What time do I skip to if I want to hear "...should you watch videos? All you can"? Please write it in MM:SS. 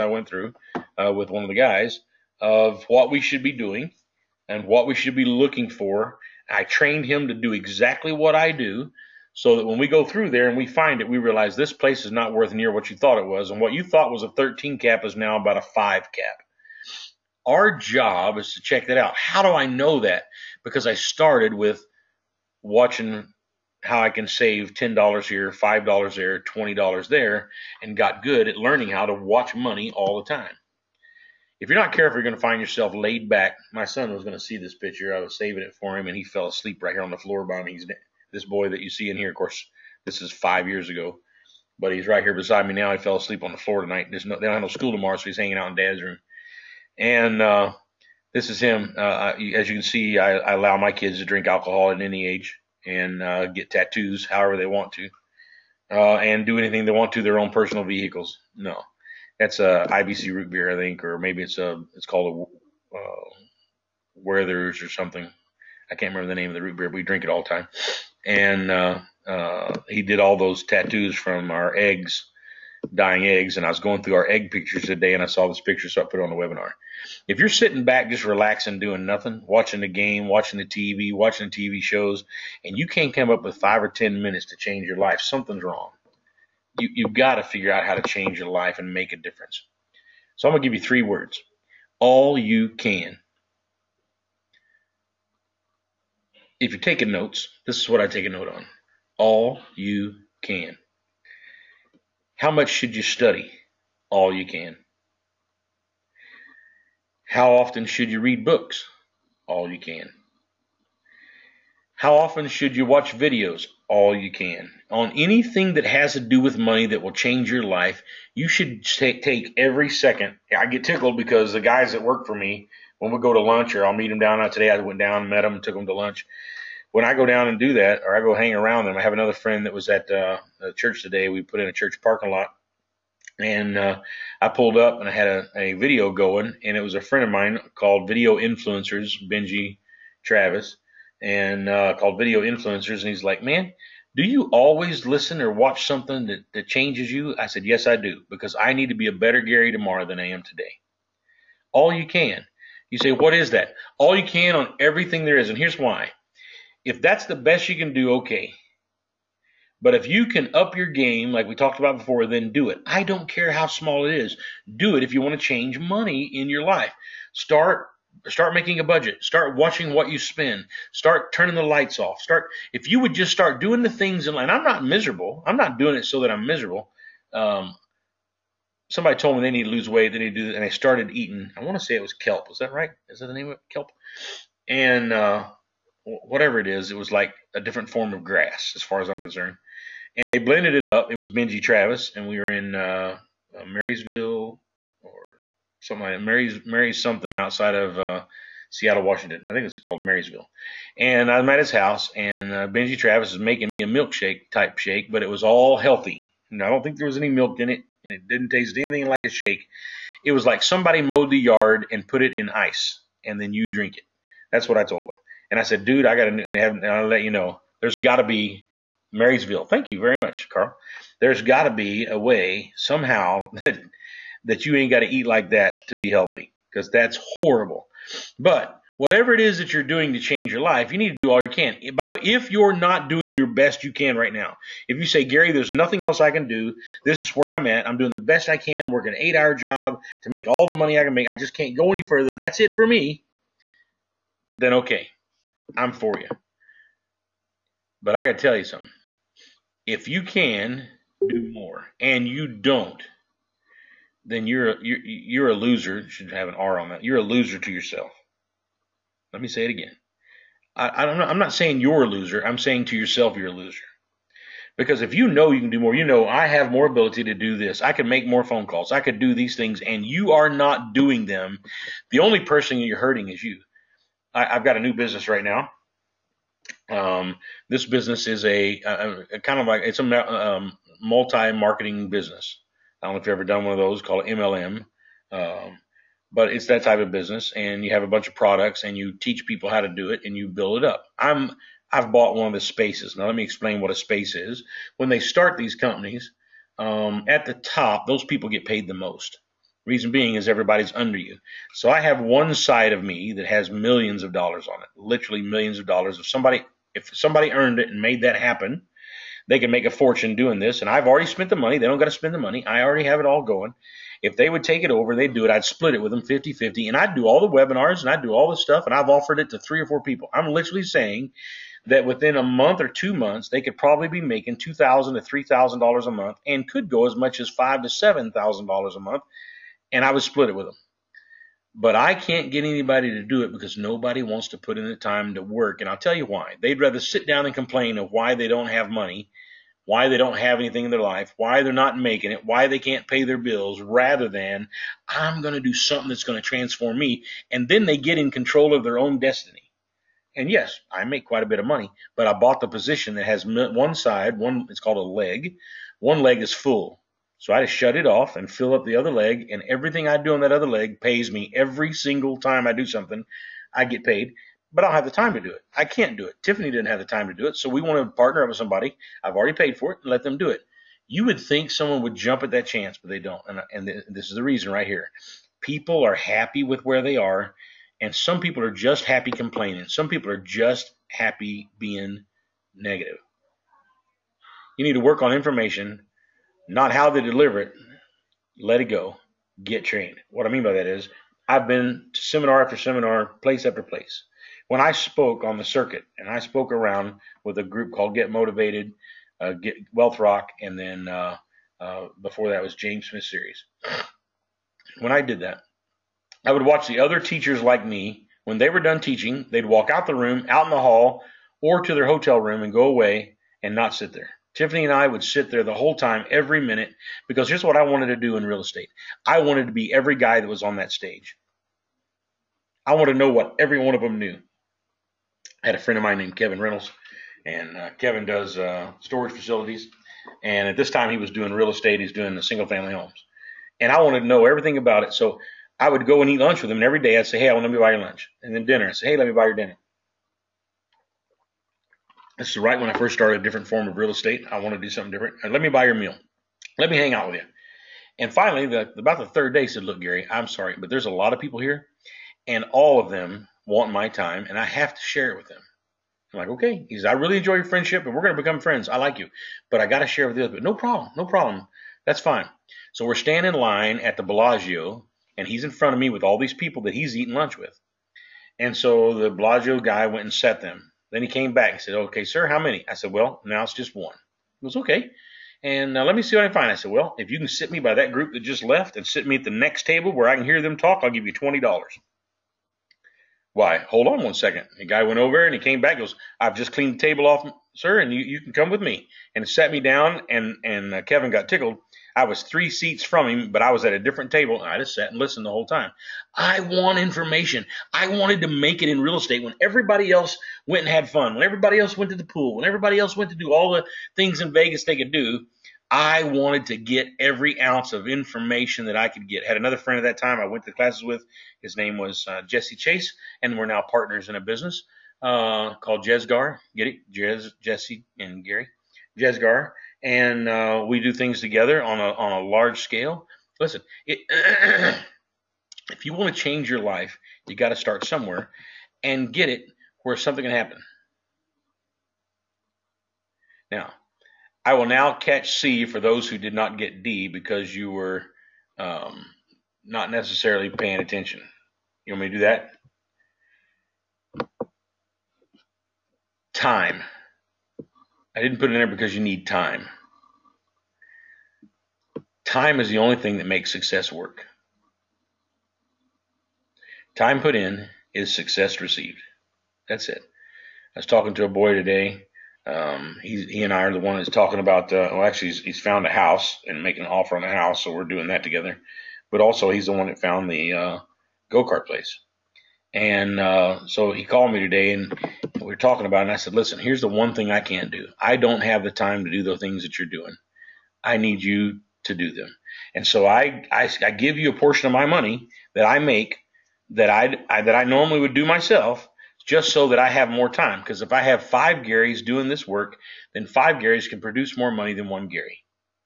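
01:52.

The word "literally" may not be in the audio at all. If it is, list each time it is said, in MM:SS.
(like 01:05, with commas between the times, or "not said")
05:04, 05:20.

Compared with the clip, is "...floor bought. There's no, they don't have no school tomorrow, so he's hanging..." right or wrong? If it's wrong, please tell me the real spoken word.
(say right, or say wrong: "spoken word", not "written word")
wrong: "tonight", not "bought".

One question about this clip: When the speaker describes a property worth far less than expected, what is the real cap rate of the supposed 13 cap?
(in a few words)
5 cap.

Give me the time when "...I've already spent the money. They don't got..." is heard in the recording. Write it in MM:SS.
05:10.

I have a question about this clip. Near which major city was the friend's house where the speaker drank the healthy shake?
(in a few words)
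Seattle.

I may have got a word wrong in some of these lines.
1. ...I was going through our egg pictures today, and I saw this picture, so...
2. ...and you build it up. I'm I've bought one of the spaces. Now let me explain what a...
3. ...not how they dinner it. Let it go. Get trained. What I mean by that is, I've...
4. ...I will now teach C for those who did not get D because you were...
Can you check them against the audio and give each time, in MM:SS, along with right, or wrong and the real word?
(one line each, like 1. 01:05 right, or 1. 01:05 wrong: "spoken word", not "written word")
1. 01:13 right
2. 04:50 right
3. 06:26 wrong: "deliver", not "dinner"
4. 08:54 wrong: "catch", not "teach".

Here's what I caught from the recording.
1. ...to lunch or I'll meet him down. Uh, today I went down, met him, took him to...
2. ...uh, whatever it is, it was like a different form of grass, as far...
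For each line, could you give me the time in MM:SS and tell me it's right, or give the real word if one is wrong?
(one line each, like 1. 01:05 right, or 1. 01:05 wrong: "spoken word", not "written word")
1. 02:03 right
2. 03:05 right.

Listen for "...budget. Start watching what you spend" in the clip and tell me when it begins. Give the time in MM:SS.
02:48.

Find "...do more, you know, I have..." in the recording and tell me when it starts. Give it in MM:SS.
04:25.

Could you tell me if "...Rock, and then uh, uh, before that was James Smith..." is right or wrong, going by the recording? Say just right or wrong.
right.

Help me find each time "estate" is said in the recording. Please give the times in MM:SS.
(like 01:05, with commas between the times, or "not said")
06:58, 07:11, 07:24, 08:19.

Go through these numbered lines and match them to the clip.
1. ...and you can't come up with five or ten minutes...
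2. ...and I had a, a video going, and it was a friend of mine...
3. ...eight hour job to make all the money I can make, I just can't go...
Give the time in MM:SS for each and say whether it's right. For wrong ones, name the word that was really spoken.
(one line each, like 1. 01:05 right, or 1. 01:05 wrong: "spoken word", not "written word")
1. 01:22 right
2. 02:14 right
3. 03:59 right.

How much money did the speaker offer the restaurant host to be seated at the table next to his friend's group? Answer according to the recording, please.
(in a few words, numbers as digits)
$20.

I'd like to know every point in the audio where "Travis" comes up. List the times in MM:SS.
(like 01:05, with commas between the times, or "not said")
02:20, 03:11, 03:22.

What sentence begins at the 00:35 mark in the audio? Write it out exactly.
I was saving it for him, and he fell asleep right here on the floor by me.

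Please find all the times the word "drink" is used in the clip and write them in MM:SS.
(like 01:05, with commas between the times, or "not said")
00:51, 01:07, 03:33.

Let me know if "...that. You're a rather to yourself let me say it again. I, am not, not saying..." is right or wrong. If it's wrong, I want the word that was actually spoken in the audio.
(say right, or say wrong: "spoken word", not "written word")
wrong: "loser", not "rather".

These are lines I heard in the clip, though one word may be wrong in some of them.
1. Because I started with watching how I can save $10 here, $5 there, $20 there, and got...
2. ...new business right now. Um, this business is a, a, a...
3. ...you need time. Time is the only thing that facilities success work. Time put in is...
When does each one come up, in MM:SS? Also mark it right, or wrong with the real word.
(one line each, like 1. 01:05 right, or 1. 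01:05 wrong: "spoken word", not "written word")
1. 00:20 right
2. 04:34 right
3. 09:09 wrong: "makes", not "facilities".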